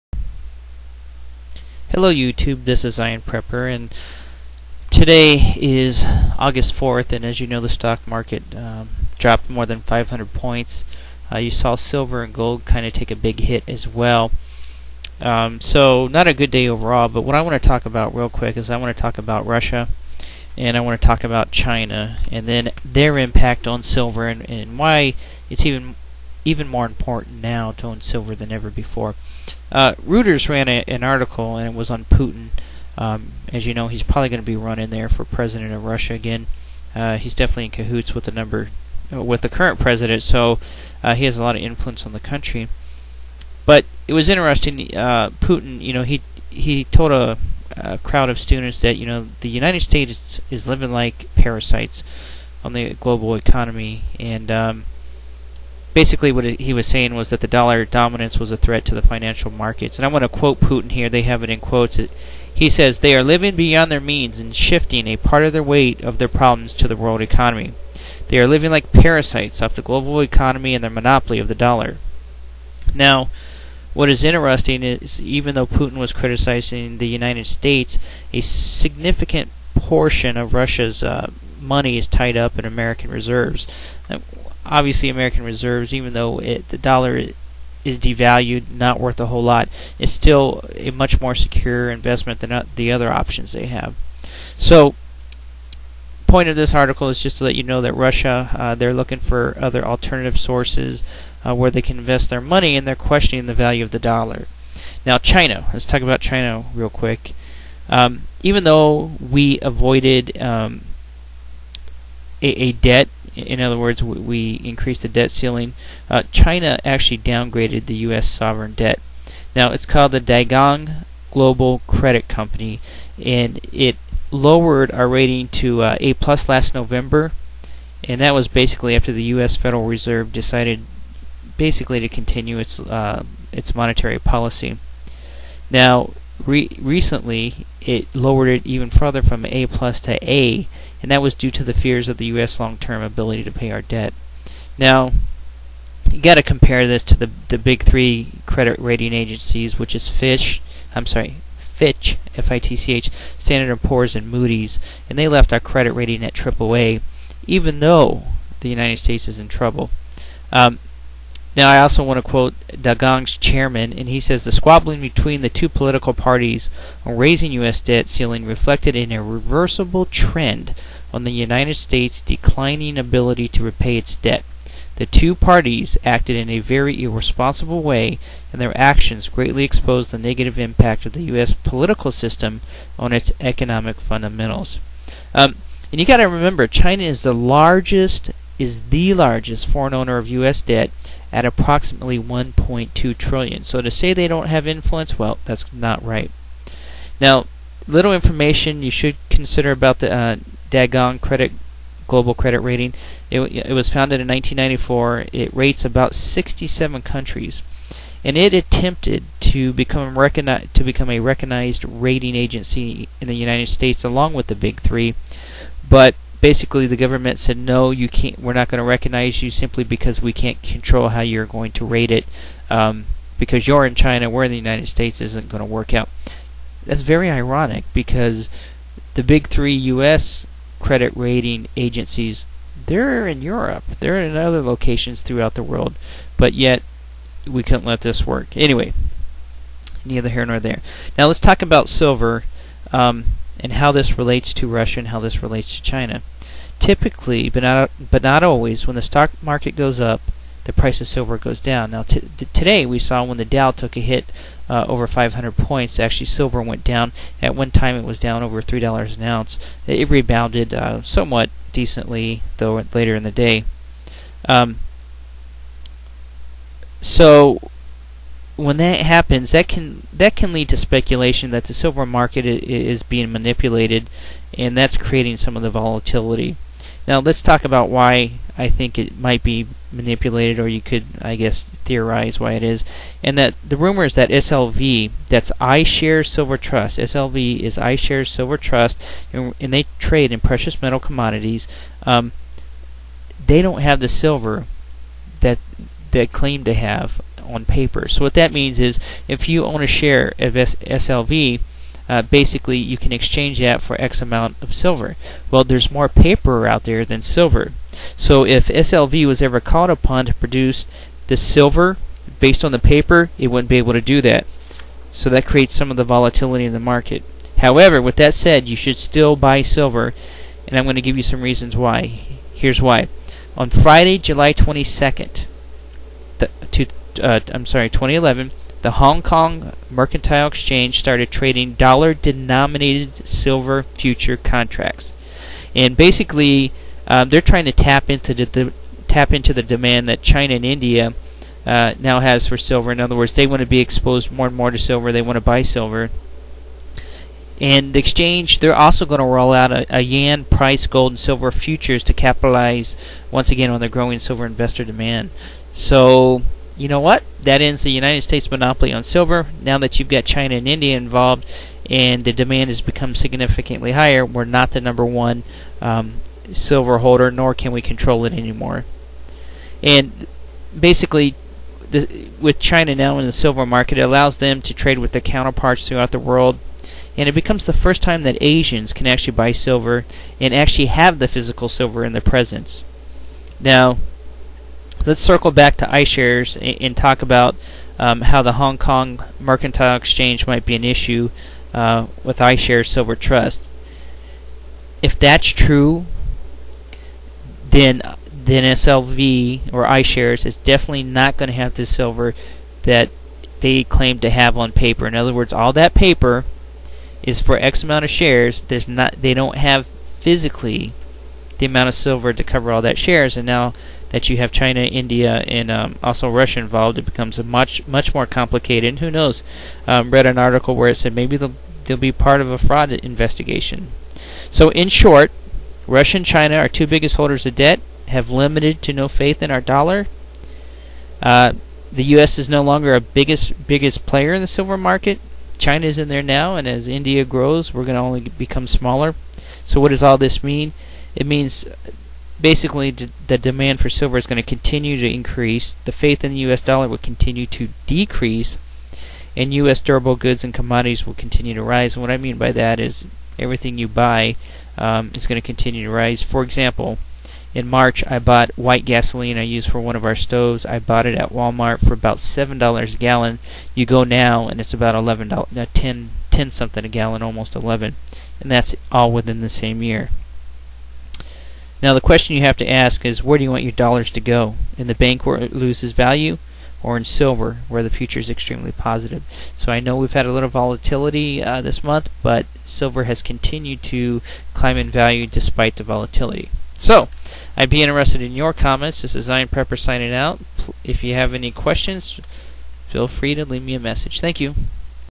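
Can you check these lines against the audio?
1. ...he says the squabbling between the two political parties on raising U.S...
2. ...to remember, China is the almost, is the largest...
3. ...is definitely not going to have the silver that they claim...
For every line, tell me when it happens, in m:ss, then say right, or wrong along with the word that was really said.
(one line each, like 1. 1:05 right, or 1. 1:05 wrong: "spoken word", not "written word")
1. 2:44 right
2. 3:06 wrong: "largest", not "almost"
3. 6:40 right.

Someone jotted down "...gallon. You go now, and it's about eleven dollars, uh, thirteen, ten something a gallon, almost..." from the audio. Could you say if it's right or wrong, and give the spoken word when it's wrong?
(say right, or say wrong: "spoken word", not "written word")
wrong: "ten", not "thirteen".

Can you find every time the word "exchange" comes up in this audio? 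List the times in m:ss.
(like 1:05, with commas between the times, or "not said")
5:03, 5:30, 5:47, 6:29.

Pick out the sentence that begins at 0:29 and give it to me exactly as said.
Uh, Reuters ran a, an article, and it was on Putin.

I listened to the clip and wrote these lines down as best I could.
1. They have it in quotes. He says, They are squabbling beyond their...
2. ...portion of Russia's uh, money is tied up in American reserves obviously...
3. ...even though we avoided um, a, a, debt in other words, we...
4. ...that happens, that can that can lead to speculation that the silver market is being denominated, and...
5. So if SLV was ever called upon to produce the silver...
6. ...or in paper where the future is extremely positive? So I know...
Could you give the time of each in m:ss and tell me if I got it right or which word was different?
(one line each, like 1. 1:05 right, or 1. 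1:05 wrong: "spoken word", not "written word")
1. 1:01 wrong: "living", not "squabbling"
2. 1:19 right
3. 1:48 right
4. 4:28 wrong: "manipulated", not "denominated"
5. 5:08 right
6. 7:56 wrong: "silver", not "paper".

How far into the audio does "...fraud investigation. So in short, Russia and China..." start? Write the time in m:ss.
7:02.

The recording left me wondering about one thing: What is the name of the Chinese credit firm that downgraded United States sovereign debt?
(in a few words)
Dagong Global Credit Company.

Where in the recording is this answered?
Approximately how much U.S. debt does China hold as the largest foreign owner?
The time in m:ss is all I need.
3:12.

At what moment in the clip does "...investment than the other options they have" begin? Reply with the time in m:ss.
1:31.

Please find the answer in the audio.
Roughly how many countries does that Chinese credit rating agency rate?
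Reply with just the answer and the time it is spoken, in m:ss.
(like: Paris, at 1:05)
67, at 3:26.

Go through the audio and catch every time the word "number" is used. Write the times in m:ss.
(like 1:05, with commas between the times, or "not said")
0:38, 6:04.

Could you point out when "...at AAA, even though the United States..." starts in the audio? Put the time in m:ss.
2:36.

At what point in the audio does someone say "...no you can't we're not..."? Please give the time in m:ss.
3:37.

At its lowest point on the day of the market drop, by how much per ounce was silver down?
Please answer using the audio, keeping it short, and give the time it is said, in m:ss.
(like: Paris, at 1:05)
3 dollars, at 4:18.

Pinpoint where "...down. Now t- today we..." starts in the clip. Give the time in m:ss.
4:11.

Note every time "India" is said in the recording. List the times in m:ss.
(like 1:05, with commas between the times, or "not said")
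5:40, 6:00, 6:54, 7:16.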